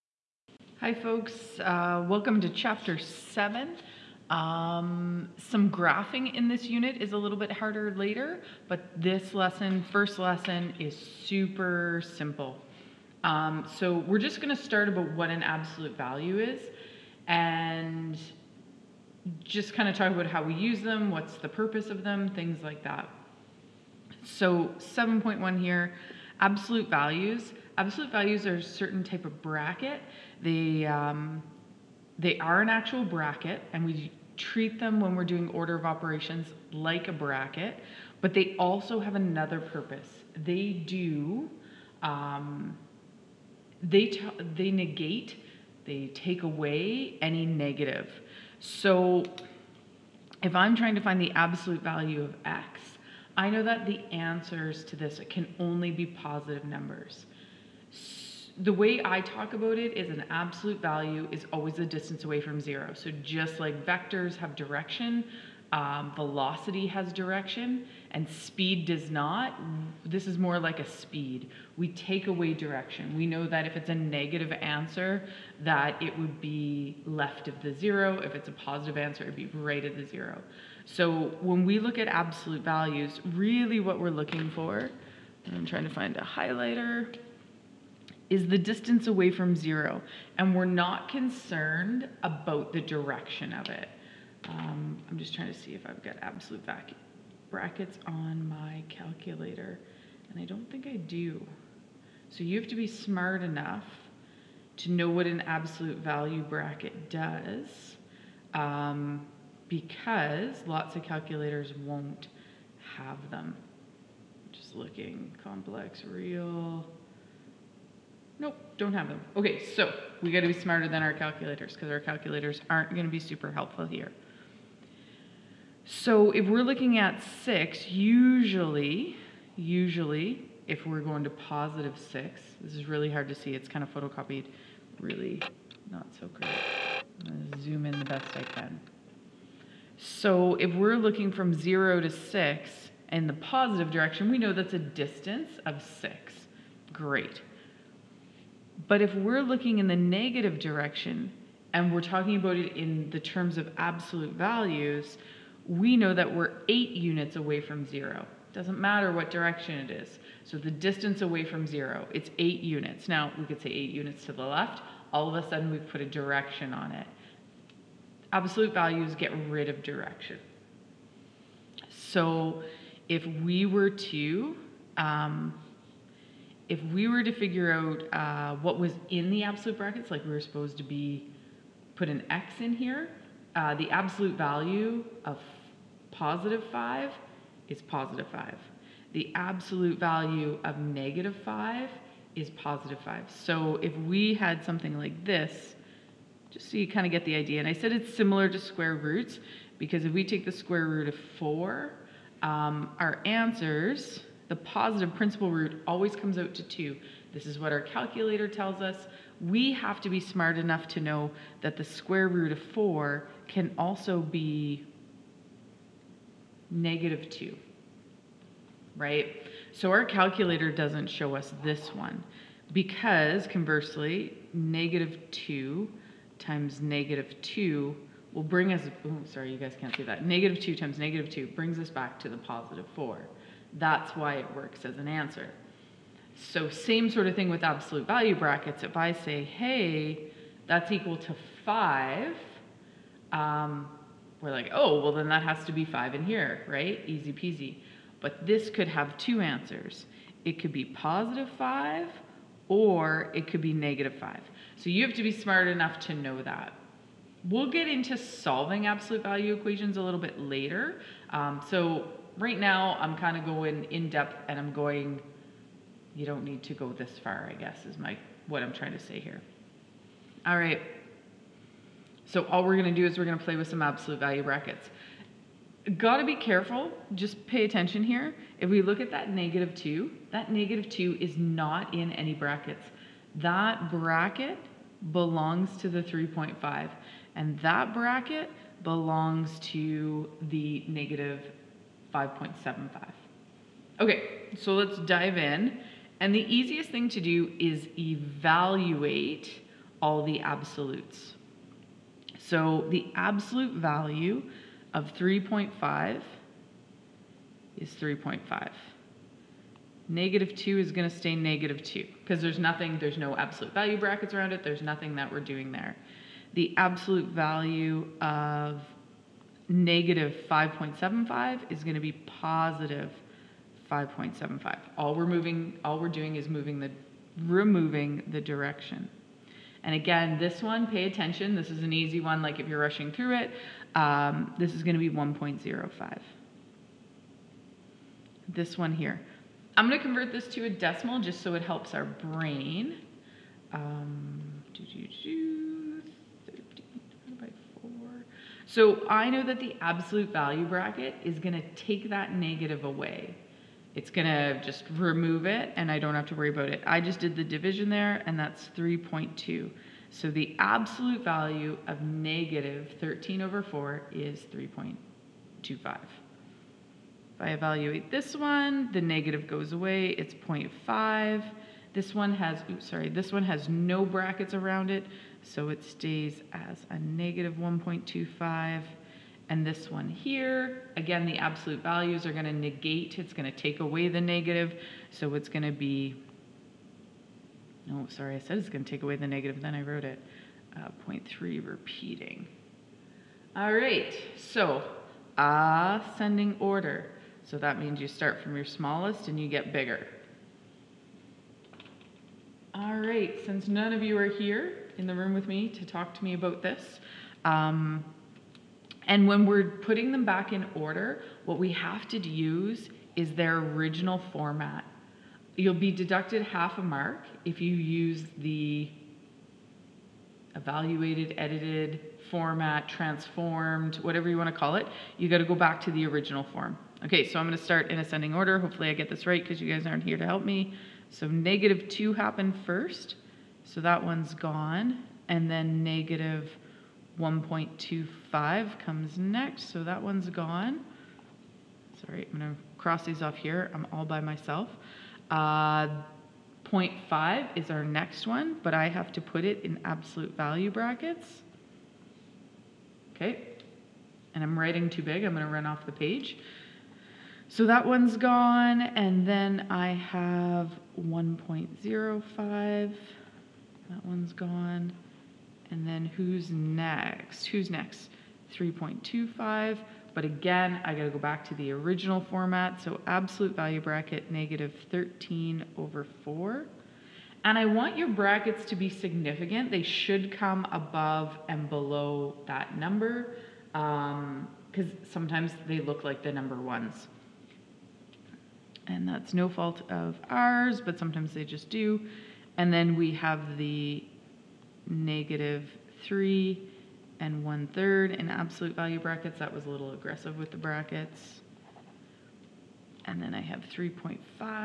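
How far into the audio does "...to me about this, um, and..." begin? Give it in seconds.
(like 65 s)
406 s.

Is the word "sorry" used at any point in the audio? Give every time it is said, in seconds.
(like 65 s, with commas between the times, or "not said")
229 s, 372 s, 388 s, 442 s.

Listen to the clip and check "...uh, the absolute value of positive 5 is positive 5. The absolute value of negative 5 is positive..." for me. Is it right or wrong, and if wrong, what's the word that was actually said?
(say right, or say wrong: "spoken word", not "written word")
right.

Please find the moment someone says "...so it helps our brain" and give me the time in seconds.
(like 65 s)
341 s.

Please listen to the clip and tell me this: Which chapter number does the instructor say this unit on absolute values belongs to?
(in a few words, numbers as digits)
7.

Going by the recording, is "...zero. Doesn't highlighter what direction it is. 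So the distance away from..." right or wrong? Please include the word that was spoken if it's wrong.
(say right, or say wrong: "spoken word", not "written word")
wrong: "matter", not "highlighter".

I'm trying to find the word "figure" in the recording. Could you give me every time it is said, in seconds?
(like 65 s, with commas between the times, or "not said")
177 s.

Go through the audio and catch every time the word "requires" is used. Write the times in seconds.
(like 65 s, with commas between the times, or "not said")
not said.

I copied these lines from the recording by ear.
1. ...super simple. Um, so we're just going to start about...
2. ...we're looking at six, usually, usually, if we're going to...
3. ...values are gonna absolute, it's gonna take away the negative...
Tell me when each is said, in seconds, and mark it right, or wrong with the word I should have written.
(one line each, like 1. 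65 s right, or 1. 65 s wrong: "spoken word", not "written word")
1. 10 s right
2. 126 s right
3. 381 s wrong: "negate", not "absolute".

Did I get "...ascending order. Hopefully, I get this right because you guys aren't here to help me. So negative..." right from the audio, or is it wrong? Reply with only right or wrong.
right.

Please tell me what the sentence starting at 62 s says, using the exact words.
So just like vectors have direction, um, velocity has direction, and speed does not, this is more like a speed.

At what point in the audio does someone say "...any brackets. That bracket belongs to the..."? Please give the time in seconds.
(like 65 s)
282 s.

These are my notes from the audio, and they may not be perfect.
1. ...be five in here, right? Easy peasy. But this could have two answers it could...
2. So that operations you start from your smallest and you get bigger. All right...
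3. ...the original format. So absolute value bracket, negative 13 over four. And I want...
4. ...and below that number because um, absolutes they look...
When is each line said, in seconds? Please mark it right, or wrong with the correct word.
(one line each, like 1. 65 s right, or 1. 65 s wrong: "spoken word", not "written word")
1. 245 s right
2. 397 s wrong: "means", not "operations"
3. 471 s right
4. 481 s wrong: "sometimes", not "absolutes".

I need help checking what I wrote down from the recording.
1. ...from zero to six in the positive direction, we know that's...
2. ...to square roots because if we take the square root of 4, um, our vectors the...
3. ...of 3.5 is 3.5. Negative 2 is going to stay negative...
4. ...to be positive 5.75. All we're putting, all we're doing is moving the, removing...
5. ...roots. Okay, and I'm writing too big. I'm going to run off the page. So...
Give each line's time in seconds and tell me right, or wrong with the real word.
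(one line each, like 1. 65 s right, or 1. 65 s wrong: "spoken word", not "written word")
1. 141 s right
2. 198 s wrong: "answers", not "vectors"
3. 304 s right
4. 321 s wrong: "moving", not "putting"
5. 450 s wrong: "brackets", not "roots".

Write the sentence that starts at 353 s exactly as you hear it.
It's going to just remove it and I don't have to worry about it.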